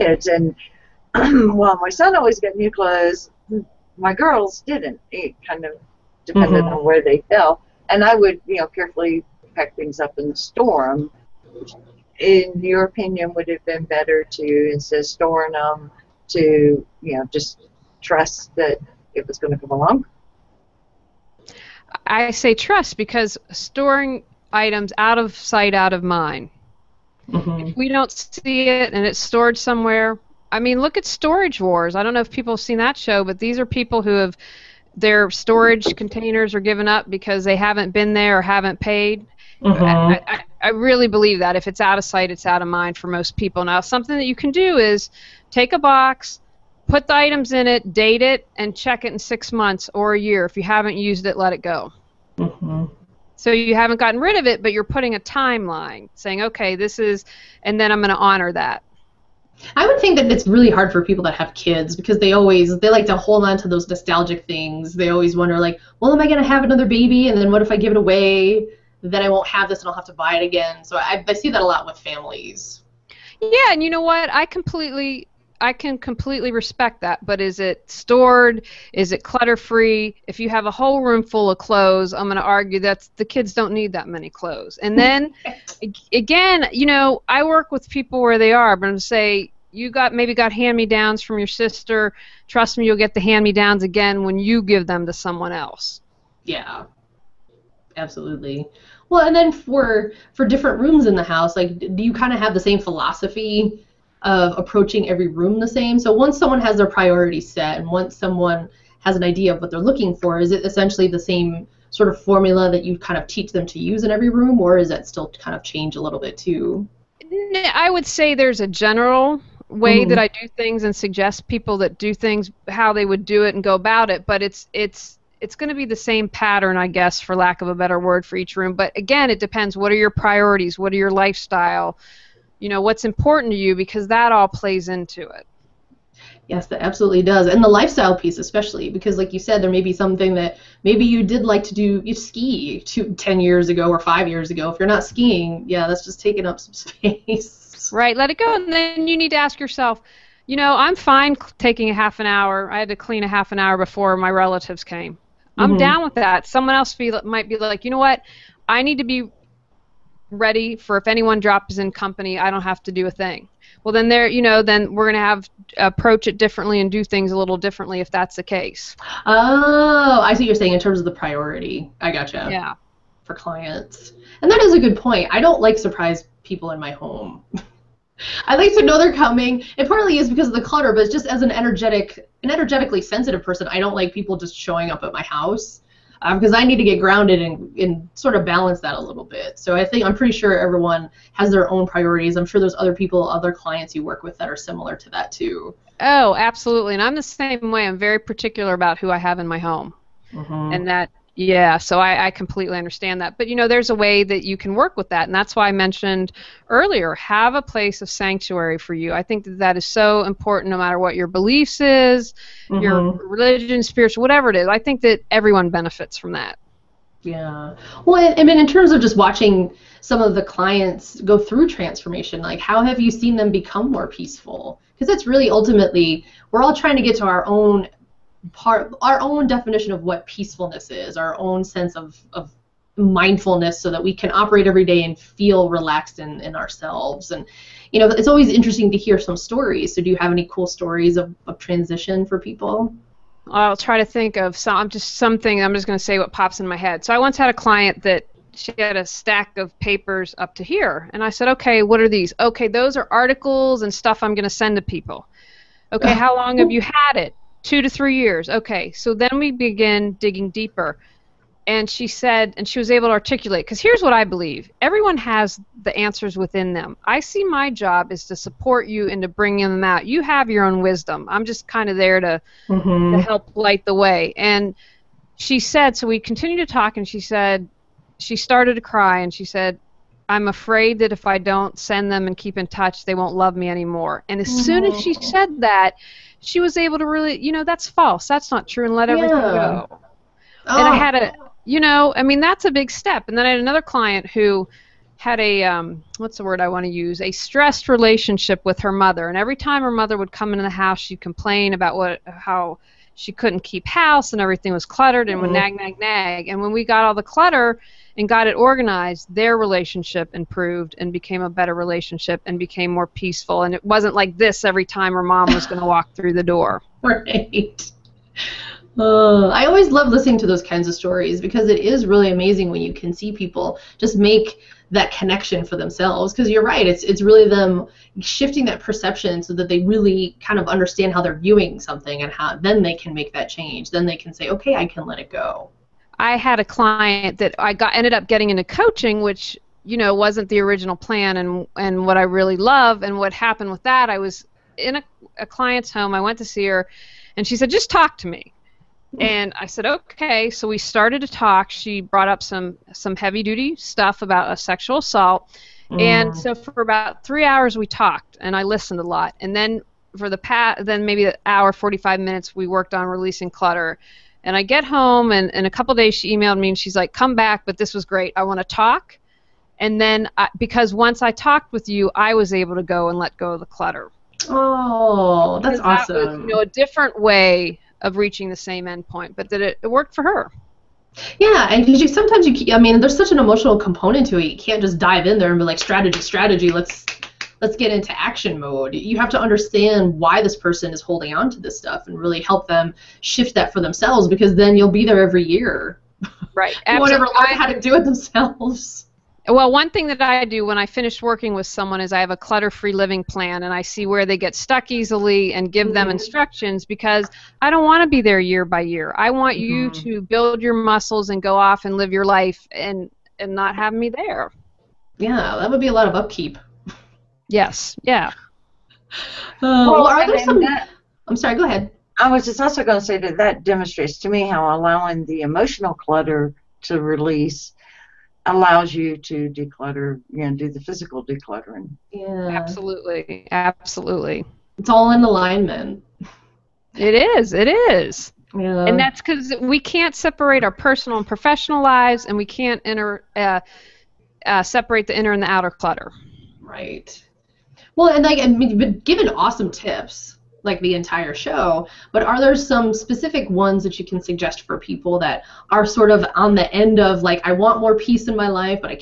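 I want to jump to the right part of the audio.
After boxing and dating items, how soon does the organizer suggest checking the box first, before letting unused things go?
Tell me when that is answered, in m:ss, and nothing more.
0:49.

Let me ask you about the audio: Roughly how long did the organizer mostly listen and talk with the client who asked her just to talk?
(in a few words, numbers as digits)
3 hours.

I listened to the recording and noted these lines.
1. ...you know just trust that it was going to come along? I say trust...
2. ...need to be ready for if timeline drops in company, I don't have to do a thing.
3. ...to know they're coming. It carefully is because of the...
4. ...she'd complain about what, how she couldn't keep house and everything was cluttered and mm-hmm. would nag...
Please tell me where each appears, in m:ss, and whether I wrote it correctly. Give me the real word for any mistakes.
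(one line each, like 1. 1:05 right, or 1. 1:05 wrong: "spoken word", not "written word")
1. 0:16 right
2. 2:38 wrong: "anyone", not "timeline"
3. 2:58 wrong: "partly", not "carefully"
4. 5:00 right.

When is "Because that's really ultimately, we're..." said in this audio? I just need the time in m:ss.
3:44.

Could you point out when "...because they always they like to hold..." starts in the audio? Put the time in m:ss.
1:01.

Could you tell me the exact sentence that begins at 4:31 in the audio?
I'm just kind of there to, mm-hmm.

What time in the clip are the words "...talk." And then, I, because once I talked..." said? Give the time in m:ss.
6:08.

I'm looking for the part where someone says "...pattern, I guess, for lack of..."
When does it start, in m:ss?
2:06.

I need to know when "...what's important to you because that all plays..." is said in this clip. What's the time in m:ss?
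2:12.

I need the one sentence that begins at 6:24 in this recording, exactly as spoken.
You can't just dive in there and be like strategy, strategy.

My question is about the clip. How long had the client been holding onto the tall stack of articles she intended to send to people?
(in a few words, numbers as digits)
2 to 3 years.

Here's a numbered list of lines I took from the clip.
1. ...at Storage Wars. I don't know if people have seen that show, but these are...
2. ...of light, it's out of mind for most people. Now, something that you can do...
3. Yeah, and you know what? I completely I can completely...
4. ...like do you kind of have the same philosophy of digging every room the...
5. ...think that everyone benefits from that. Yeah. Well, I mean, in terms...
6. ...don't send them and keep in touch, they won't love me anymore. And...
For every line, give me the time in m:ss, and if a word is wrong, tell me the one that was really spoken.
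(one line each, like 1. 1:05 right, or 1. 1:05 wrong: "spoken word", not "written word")
1. 0:30 right
2. 0:41 wrong: "sight", not "light"
3. 1:13 right
4. 1:41 wrong: "approaching", not "digging"
5. 3:34 right
6. 4:41 right.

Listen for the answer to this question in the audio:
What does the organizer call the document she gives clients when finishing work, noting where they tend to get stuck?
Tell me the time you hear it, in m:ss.
6:42.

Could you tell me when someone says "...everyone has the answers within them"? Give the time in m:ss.
4:24.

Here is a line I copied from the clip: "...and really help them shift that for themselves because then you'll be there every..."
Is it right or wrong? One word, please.
right.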